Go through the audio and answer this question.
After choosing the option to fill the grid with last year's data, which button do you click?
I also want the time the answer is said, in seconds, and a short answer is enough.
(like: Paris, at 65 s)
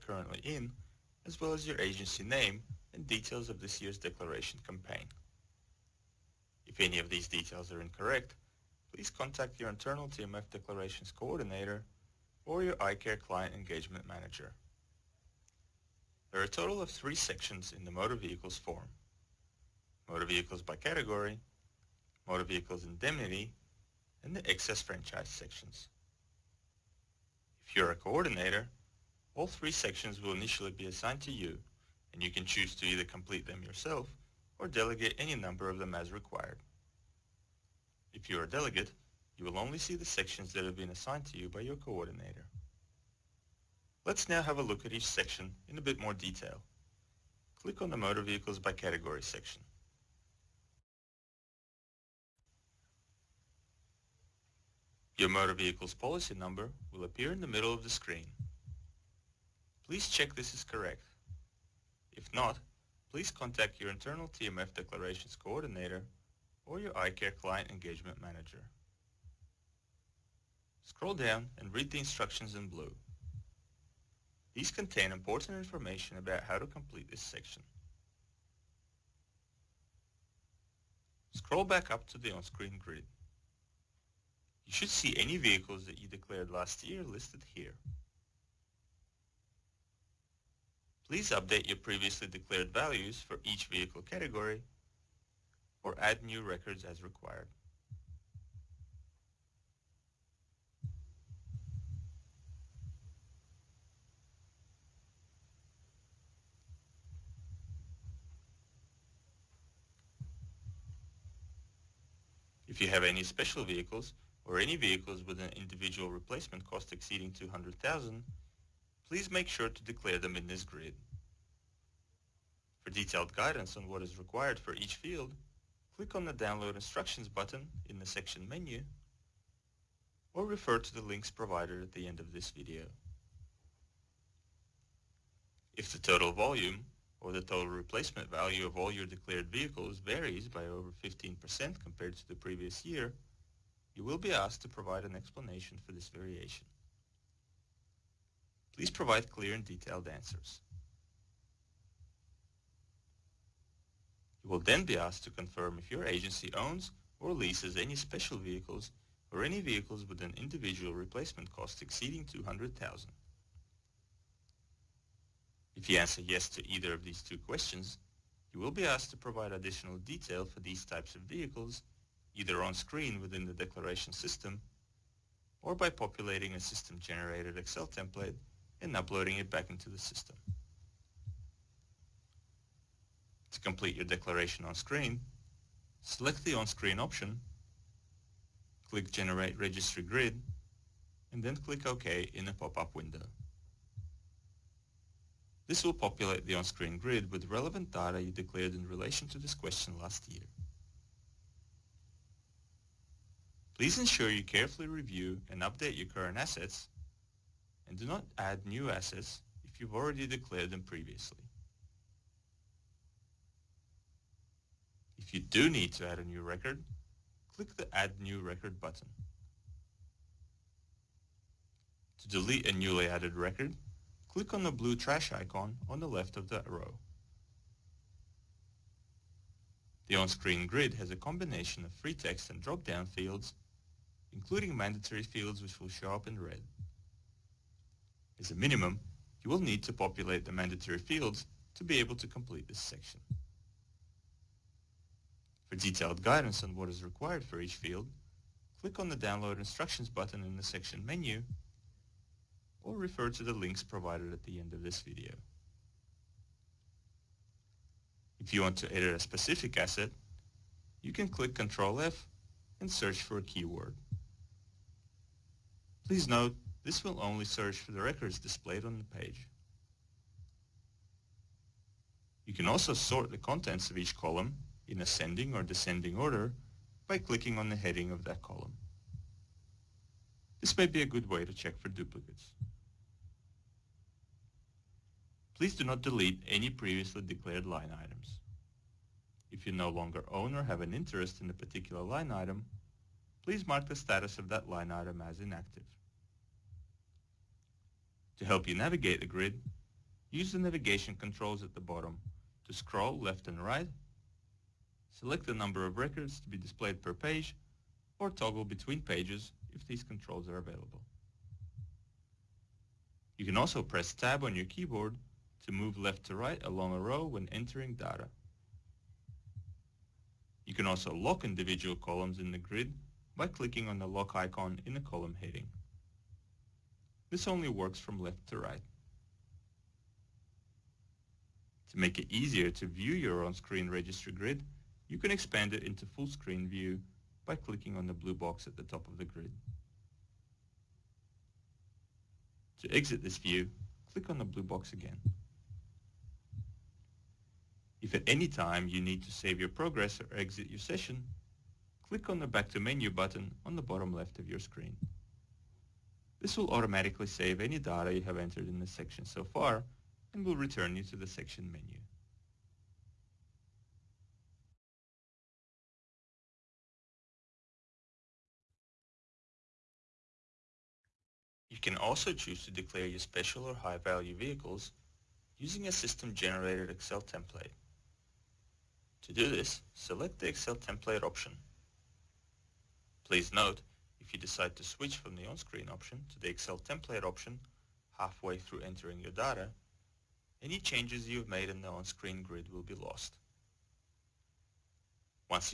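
Generate Registry Grid, at 189 s.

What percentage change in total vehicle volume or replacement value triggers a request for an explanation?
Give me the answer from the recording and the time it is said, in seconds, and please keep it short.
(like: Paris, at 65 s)
15%, at 141 s.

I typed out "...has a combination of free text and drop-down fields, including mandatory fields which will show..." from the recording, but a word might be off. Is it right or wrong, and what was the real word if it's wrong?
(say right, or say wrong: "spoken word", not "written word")
right.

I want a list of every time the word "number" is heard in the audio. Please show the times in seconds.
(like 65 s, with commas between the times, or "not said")
35 s, 56 s, 305 s.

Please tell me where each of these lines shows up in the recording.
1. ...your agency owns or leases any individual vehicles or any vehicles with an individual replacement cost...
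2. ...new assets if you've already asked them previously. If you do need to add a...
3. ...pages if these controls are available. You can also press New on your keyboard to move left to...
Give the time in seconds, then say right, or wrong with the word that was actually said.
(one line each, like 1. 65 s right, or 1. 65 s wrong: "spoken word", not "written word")
1. 155 s wrong: "special", not "individual"
2. 208 s wrong: "declared", not "asked"
3. 309 s wrong: "Tab", not "New".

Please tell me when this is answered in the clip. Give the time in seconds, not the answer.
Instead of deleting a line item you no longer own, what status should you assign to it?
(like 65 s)
295 s.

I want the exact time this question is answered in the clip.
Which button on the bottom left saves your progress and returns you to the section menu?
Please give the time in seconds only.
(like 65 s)
352 s.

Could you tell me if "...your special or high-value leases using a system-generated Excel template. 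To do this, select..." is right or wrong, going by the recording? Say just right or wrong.
wrong.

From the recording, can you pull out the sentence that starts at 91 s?
Please update your previously declared values for each vehicle category or add new records as required.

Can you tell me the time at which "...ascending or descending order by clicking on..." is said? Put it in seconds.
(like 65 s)
275 s.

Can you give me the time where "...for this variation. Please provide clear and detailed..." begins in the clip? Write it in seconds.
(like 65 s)
145 s.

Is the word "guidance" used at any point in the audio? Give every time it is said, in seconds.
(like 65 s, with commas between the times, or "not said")
123 s, 246 s.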